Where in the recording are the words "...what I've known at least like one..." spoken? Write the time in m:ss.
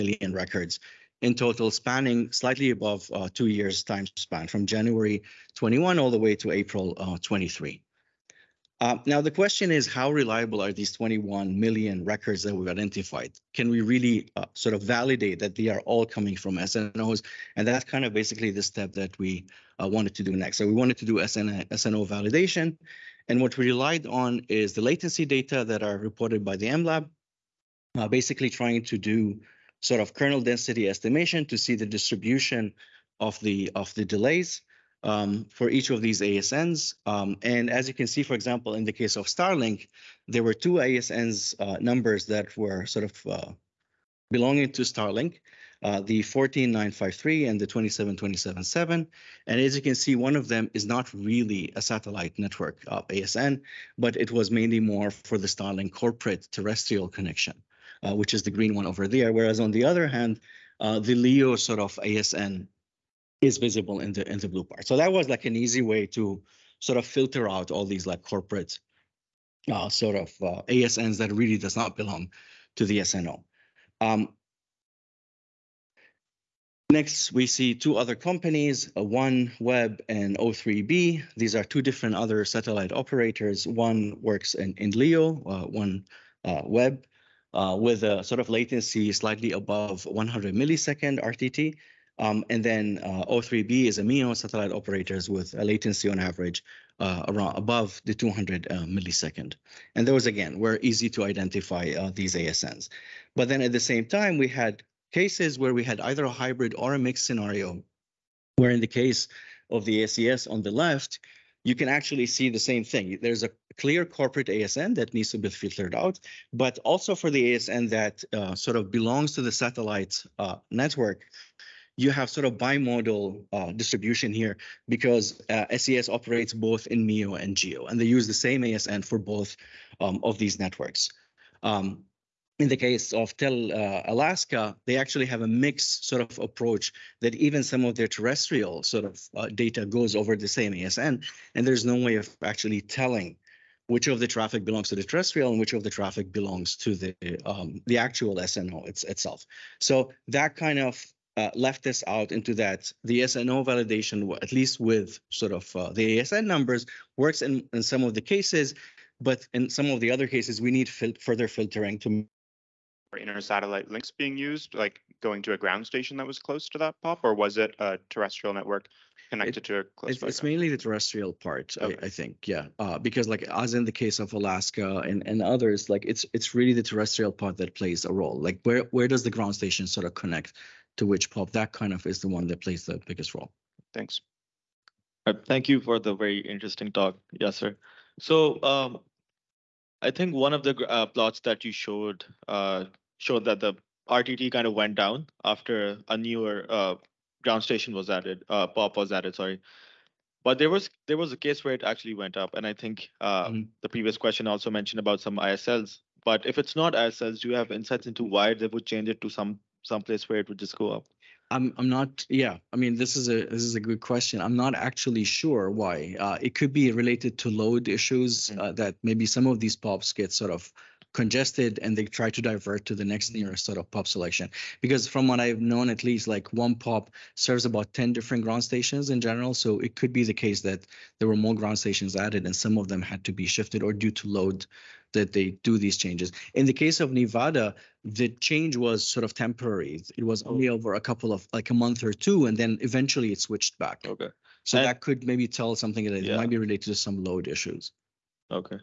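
3:45.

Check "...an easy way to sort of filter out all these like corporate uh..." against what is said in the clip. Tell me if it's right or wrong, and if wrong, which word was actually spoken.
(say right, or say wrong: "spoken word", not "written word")
right.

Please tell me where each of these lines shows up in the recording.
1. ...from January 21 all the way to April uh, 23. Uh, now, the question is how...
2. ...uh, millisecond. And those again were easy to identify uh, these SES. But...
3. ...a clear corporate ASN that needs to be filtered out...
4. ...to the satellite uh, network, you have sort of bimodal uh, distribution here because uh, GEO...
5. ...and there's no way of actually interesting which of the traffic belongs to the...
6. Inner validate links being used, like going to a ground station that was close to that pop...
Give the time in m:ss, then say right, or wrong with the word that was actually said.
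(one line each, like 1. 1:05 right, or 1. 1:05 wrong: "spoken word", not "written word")
1. 0:04 right
2. 1:38 wrong: "ASNs", not "SES"
3. 1:53 right
4. 1:59 wrong: "SES", not "GEO"
5. 2:21 wrong: "telling", not "interesting"
6. 2:43 wrong: "satellite", not "validate".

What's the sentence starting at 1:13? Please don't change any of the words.
Um, next, we see two other companies, uh, OneWeb and O3B.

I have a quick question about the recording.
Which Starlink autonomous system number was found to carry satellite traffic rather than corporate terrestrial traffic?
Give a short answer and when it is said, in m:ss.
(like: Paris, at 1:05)
14953, at 0:46.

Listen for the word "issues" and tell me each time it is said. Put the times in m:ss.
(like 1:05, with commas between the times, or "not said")
3:37, 4:07.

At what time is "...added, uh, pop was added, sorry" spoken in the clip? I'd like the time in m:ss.
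3:18.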